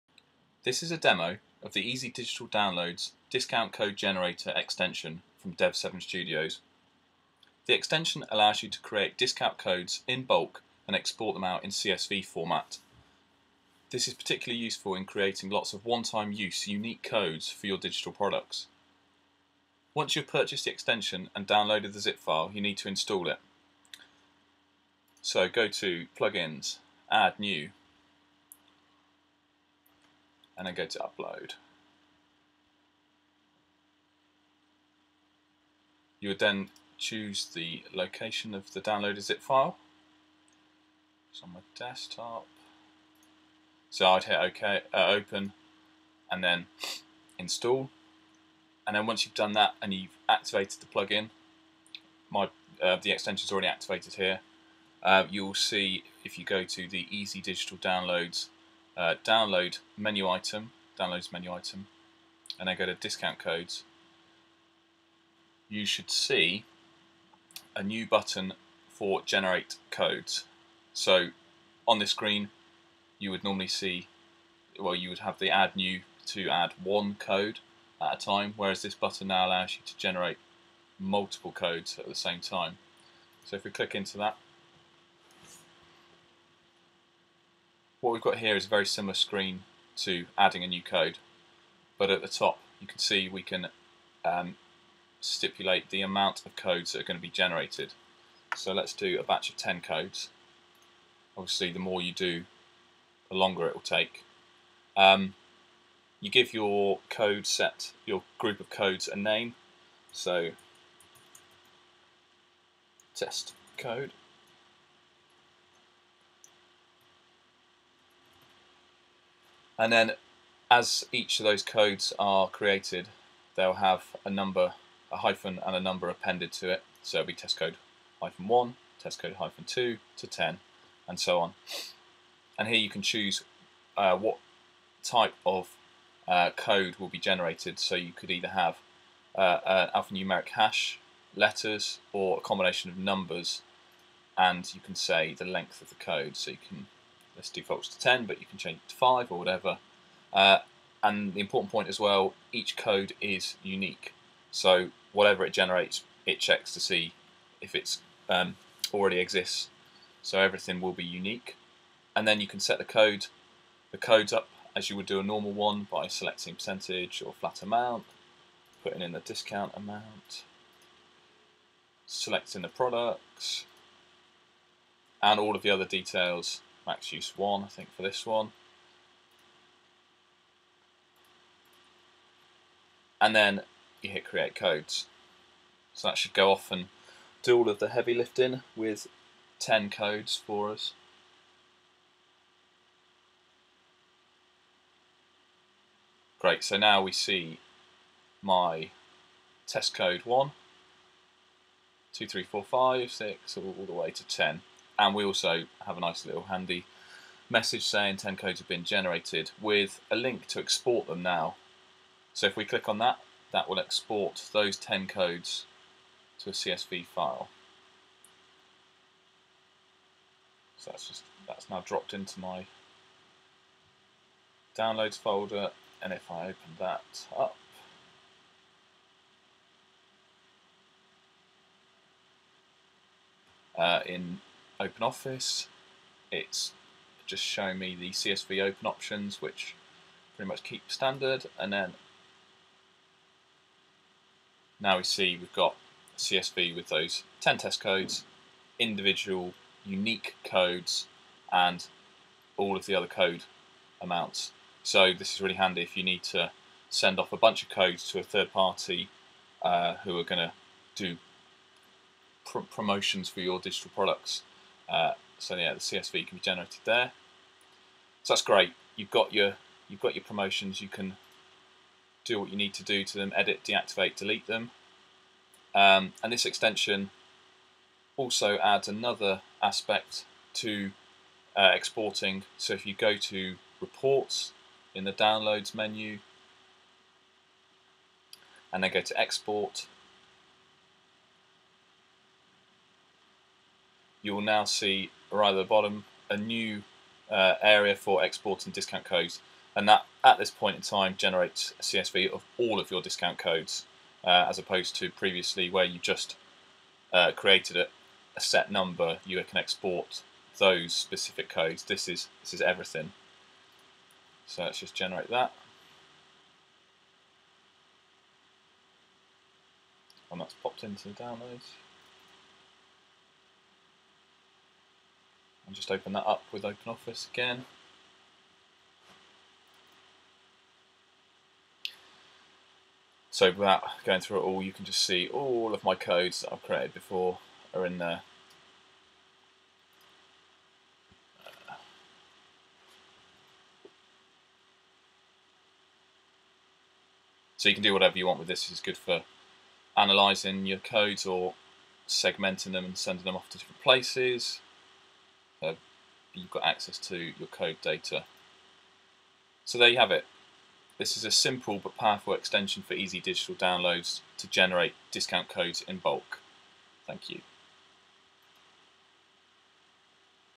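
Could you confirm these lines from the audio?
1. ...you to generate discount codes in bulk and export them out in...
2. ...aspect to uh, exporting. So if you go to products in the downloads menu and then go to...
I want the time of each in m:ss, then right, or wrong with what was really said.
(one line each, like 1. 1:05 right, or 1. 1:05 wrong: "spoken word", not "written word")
1. 0:08 wrong: "create", not "generate"
2. 4:39 wrong: "reports", not "products".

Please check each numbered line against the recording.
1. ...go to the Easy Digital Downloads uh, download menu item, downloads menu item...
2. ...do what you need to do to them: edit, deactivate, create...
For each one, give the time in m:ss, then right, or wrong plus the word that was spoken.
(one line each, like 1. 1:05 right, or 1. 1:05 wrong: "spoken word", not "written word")
1. 0:56 right
2. 4:32 wrong: "delete", not "create".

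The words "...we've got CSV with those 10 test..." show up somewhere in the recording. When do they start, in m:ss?
4:05.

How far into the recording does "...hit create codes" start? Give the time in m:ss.
3:04.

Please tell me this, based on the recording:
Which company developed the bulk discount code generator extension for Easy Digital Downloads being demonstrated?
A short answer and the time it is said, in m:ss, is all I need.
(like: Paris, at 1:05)
Dev7 Studios, at 0:05.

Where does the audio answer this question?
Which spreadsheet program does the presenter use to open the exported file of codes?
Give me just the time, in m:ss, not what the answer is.
3:54.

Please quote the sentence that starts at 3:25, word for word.
And we also have a nice little handy message saying 10 codes have been generated with a link to export them now.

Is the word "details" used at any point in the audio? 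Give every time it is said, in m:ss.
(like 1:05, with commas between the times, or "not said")
2:55.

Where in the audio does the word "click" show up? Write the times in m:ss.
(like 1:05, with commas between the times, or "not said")
1:23, 3:32.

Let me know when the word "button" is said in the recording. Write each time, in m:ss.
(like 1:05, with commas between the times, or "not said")
1:08, 1:18.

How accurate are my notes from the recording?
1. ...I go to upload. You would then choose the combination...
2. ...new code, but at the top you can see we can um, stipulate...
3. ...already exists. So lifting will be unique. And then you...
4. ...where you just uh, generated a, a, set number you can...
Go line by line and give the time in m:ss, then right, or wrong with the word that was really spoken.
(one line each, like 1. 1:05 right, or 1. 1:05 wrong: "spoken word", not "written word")
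1. 0:30 wrong: "location", not "combination"
2. 1:30 right
3. 2:38 wrong: "everything", not "lifting"
4. 5:05 wrong: "created", not "generated".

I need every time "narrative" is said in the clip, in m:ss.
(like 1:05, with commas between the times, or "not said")
not said.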